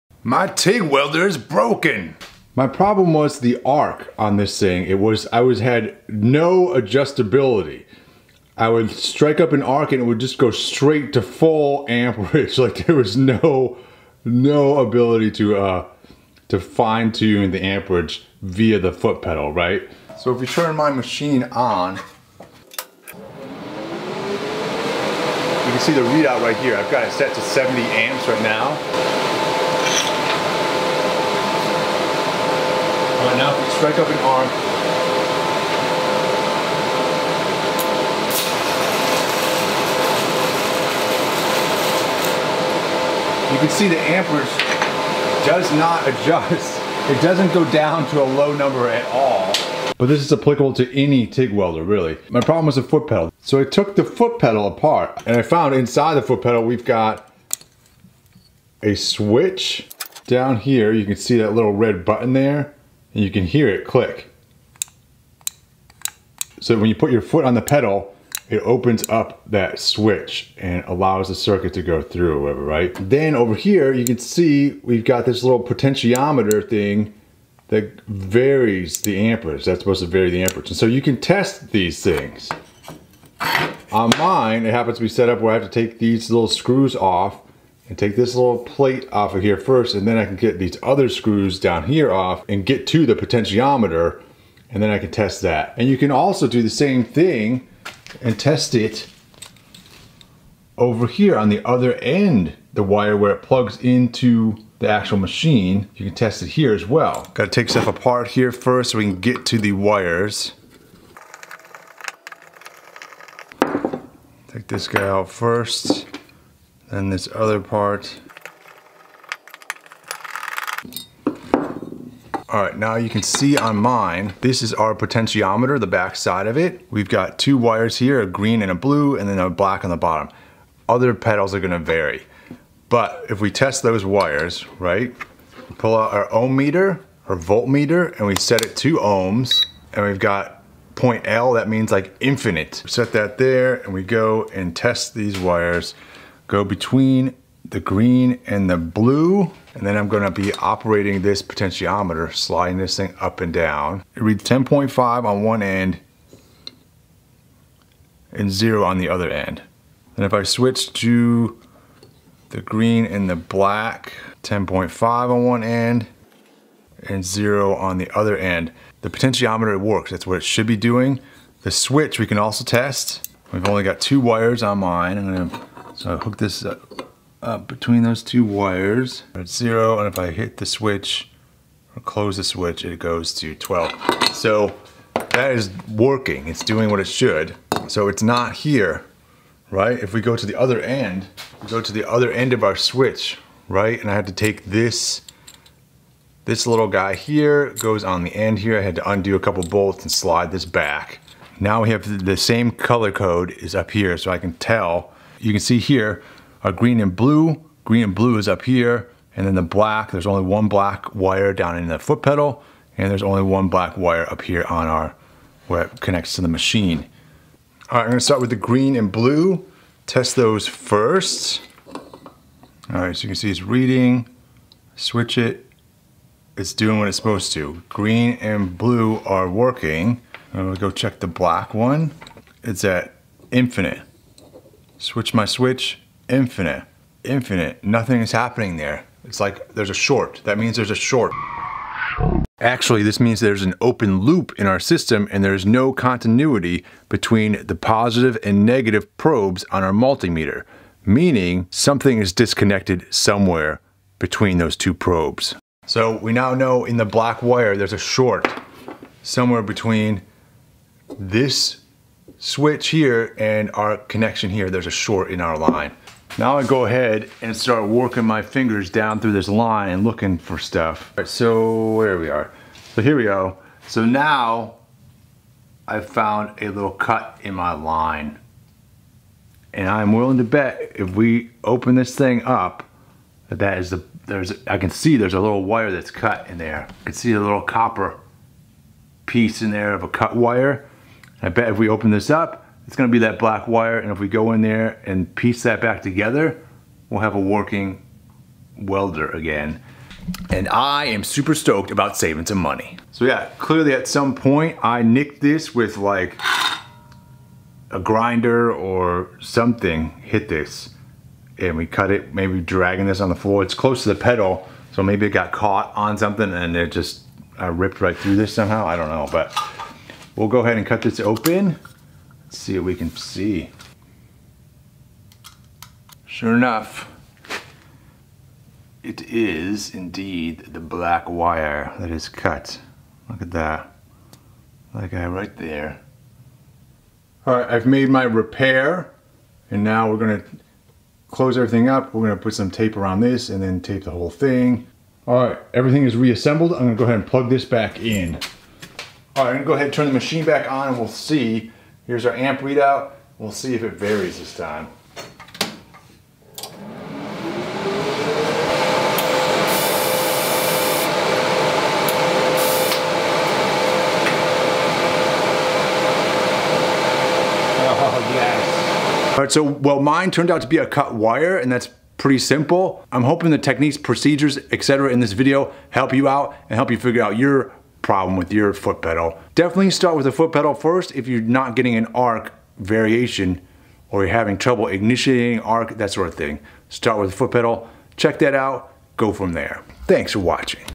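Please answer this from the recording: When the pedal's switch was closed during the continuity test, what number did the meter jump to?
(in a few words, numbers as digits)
12.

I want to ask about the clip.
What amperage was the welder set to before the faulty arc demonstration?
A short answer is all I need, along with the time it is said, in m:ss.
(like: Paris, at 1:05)
70 amps, at 0:27.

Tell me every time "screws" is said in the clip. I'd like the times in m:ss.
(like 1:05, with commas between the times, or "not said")
1:26, 1:31.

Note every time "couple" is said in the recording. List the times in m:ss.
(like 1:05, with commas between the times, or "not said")
3:19.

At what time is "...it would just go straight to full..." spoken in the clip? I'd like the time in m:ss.
0:10.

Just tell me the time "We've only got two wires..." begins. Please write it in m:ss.
2:53.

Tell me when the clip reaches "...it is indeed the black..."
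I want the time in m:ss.
5:29.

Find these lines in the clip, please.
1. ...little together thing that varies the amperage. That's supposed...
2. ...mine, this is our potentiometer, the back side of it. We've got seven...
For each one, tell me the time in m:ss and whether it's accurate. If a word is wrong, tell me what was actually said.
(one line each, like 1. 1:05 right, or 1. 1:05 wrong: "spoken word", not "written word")
1. 1:15 wrong: "potentiometer", not "together"
2. 2:03 wrong: "two", not "seven".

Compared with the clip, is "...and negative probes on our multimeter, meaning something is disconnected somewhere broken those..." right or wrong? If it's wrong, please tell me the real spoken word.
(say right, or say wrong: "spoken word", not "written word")
wrong: "between", not "broken".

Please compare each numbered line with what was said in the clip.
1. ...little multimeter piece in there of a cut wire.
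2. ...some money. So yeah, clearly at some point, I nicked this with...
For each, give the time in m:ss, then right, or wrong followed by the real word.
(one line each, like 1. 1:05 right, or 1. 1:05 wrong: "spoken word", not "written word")
1. 4:47 wrong: "copper", not "multimeter"
2. 5:02 right.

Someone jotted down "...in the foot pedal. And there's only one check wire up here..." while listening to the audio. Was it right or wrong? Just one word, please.
wrong.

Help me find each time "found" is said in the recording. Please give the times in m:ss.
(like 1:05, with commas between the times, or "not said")
0:55, 4:35.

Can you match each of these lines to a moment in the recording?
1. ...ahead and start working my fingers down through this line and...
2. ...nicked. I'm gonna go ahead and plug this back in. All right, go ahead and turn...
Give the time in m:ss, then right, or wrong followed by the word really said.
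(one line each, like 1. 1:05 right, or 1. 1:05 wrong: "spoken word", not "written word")
1. 4:26 right
2. 5:46 wrong: "reassembled", not "nicked".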